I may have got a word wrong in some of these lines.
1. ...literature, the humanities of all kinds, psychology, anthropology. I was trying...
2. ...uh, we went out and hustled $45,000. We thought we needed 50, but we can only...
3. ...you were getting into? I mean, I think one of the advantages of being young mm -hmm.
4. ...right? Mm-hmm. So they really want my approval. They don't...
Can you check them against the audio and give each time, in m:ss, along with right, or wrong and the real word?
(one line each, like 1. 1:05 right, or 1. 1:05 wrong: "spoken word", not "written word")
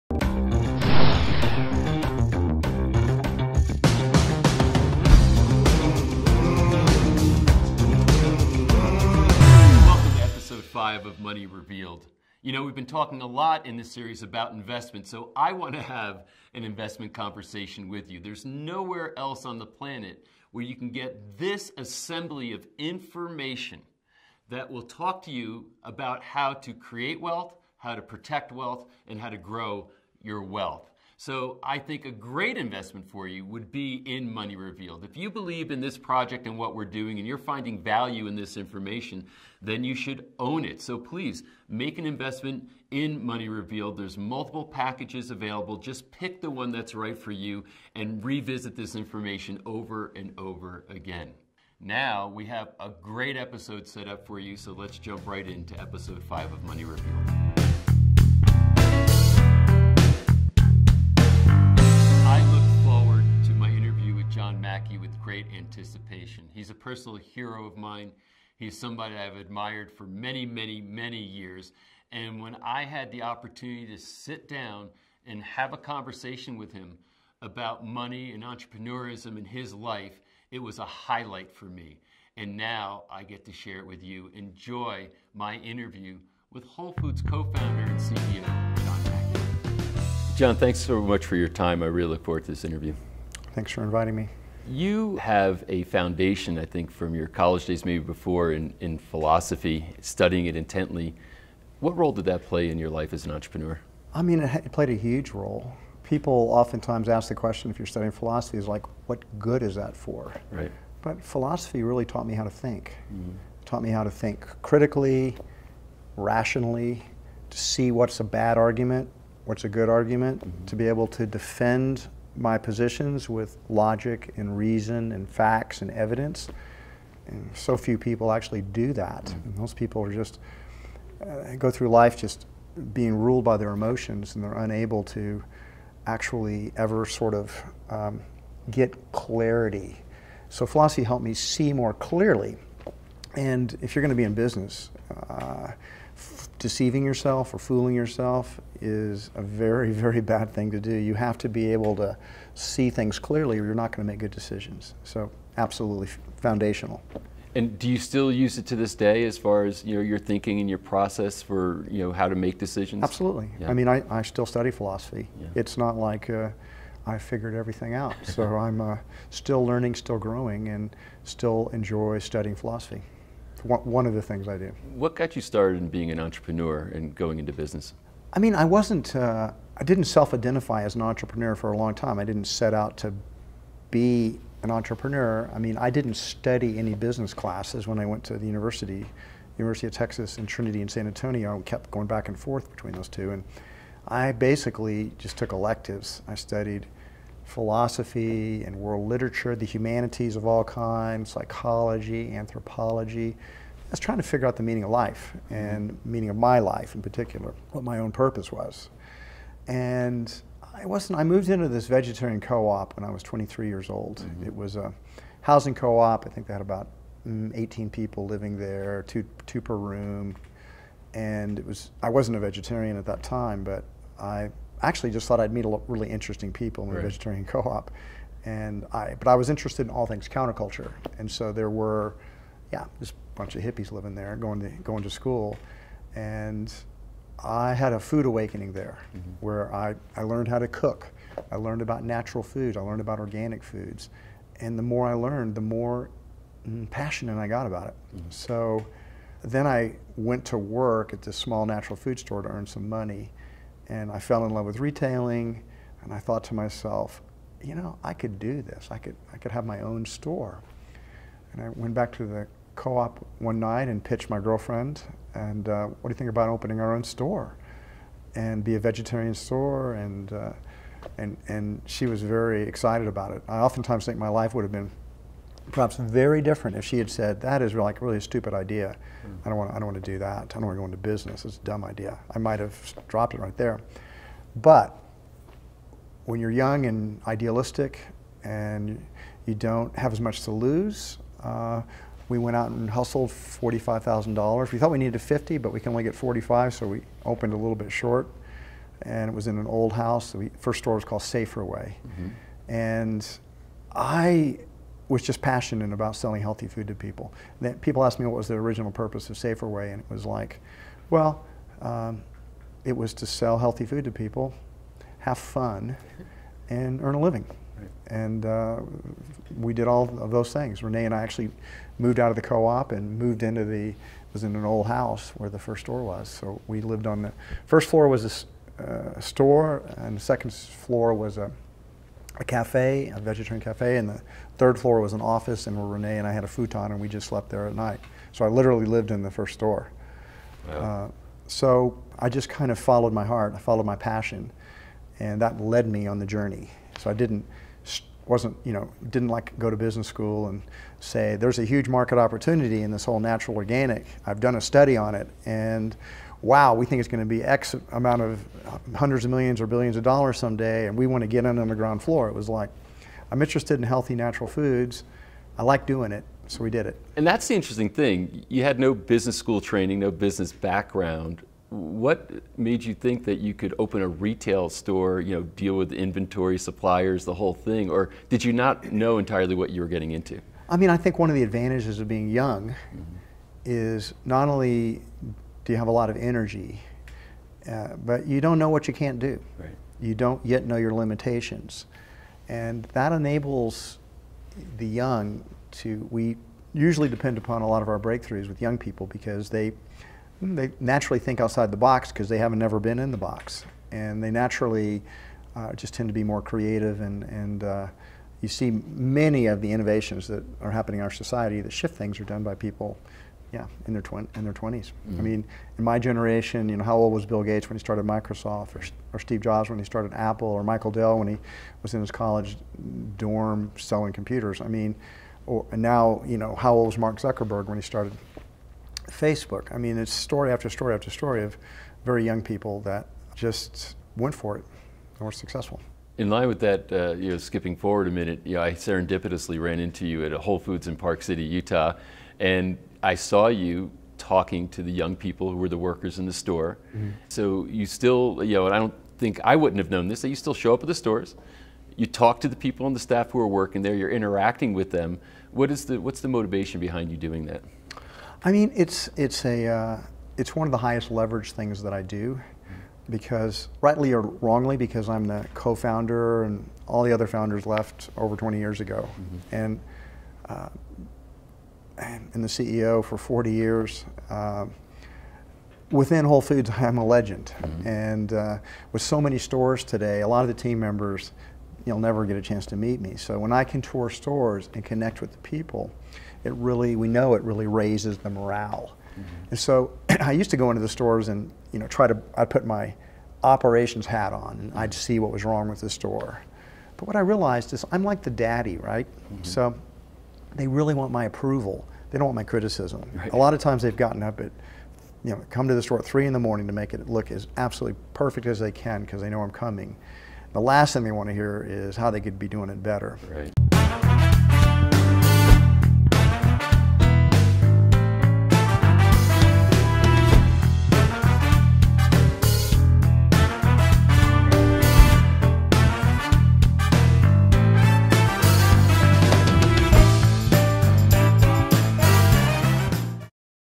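1. 3:19 right
2. 4:51 right
3. 6:19 right
4. 8:18 right.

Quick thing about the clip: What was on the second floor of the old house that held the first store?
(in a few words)
A vegetarian cafe.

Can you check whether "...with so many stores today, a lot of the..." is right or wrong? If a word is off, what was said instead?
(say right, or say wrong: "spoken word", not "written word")
right.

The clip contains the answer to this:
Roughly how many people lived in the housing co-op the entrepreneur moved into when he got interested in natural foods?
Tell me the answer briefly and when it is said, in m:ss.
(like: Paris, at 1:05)
18, at 3:37.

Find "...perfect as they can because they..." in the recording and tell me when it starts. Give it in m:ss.
8:28.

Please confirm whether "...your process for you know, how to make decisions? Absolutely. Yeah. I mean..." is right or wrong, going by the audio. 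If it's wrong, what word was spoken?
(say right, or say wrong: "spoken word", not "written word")
right.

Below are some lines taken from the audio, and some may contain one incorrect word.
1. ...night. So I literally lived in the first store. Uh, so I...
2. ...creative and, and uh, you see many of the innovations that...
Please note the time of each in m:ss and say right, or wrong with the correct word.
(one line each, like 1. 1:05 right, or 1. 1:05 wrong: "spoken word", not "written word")
1. 5:37 right
2. 6:46 right.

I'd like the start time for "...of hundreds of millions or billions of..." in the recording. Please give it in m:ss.
5:58.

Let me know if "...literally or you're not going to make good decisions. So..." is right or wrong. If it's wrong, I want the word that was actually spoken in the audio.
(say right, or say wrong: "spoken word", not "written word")
wrong: "clearly", not "literally".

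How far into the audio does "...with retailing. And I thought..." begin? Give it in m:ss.
4:14.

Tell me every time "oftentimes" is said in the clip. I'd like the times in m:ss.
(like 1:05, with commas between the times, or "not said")
1:46, 4:33.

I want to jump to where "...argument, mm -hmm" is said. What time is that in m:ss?
1:59.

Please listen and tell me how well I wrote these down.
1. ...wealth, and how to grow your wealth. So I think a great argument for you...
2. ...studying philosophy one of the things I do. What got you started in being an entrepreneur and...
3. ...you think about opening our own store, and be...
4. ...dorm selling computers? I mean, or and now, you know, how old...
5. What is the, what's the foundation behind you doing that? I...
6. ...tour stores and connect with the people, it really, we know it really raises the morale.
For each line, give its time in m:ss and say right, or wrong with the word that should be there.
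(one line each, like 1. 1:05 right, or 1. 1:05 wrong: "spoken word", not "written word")
1. 0:28 wrong: "investment", not "argument"
2. 2:52 right
3. 4:26 right
4. 7:03 right
5. 7:35 wrong: "motivation", not "foundation"
6. 8:03 right.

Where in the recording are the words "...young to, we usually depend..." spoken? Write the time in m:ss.
6:34.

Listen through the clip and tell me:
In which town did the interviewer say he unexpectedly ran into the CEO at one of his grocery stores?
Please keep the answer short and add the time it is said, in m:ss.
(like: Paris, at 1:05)
Park City, Utah, at 7:20.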